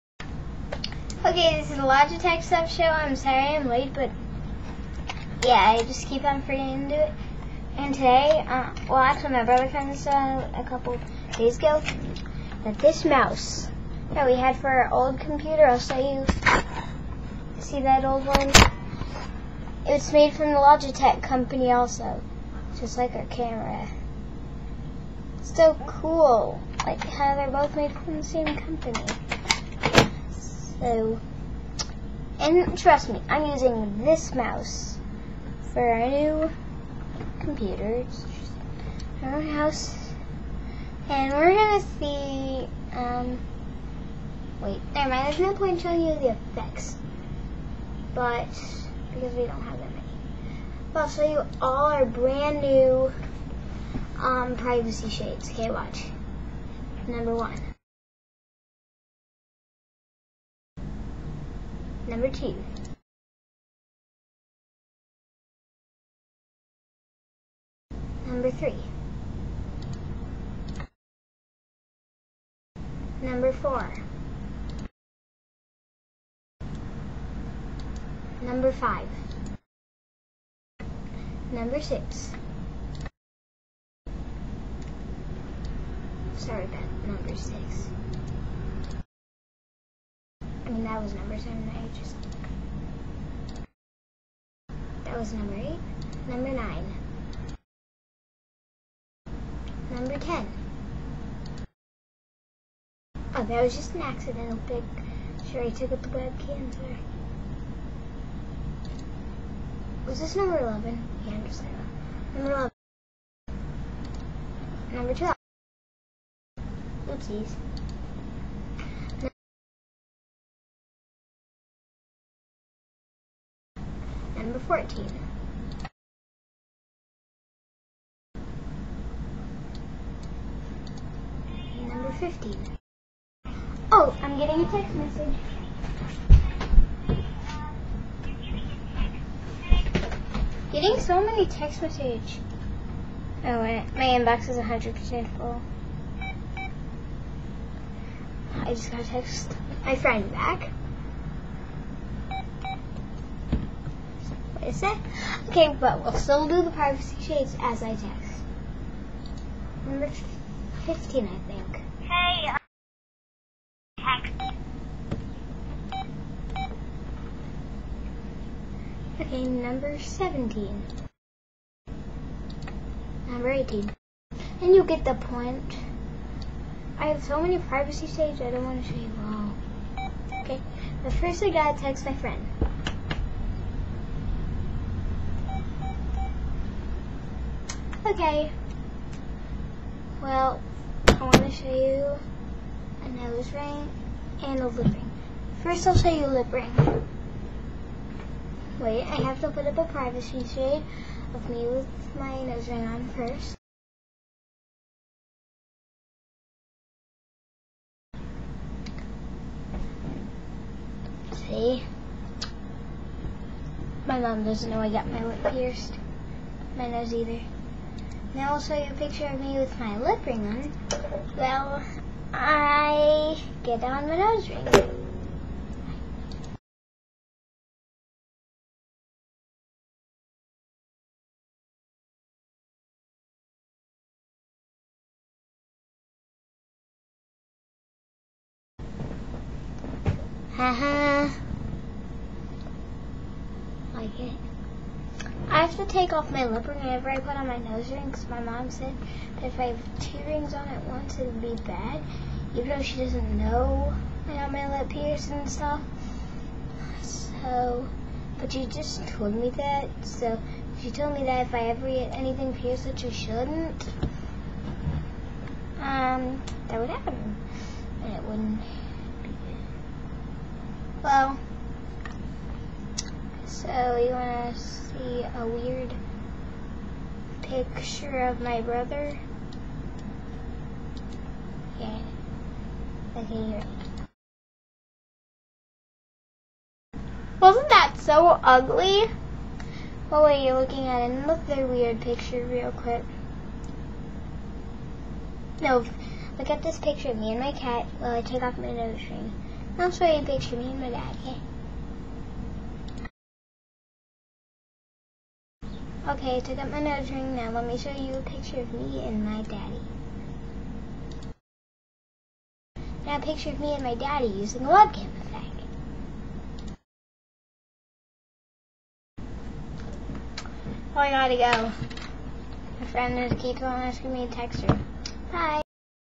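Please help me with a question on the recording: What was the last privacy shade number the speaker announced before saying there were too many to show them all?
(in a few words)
18.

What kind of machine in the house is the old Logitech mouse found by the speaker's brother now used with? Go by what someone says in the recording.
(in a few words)
new computer.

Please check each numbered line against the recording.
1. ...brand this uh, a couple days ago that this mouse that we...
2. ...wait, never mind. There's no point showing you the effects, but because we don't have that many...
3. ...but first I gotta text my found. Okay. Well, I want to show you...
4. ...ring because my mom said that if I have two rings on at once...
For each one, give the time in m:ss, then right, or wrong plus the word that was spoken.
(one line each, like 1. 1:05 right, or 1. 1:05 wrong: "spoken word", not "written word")
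1. 0:09 wrong: "found", not "brand"
2. 0:44 right
3. 3:01 wrong: "friend", not "found"
4. 4:07 right.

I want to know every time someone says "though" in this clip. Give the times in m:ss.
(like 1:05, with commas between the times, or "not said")
4:12.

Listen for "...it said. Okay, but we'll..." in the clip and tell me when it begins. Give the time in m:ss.
2:34.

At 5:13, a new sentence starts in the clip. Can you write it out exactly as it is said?
Now a picture of me and my daddy using a webcam effect.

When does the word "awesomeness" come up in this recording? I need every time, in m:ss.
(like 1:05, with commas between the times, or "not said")
not said.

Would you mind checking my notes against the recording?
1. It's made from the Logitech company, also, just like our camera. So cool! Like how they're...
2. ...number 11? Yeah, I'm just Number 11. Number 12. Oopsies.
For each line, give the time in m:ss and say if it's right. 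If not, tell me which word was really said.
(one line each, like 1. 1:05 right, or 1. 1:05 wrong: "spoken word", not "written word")
1. 0:19 right
2. 1:50 right.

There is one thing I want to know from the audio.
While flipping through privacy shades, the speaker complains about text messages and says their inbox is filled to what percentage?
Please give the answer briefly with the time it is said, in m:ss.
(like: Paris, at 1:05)
100%, at 2:24.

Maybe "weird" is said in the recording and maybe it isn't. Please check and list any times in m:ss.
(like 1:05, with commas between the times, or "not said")
4:35, 4:51.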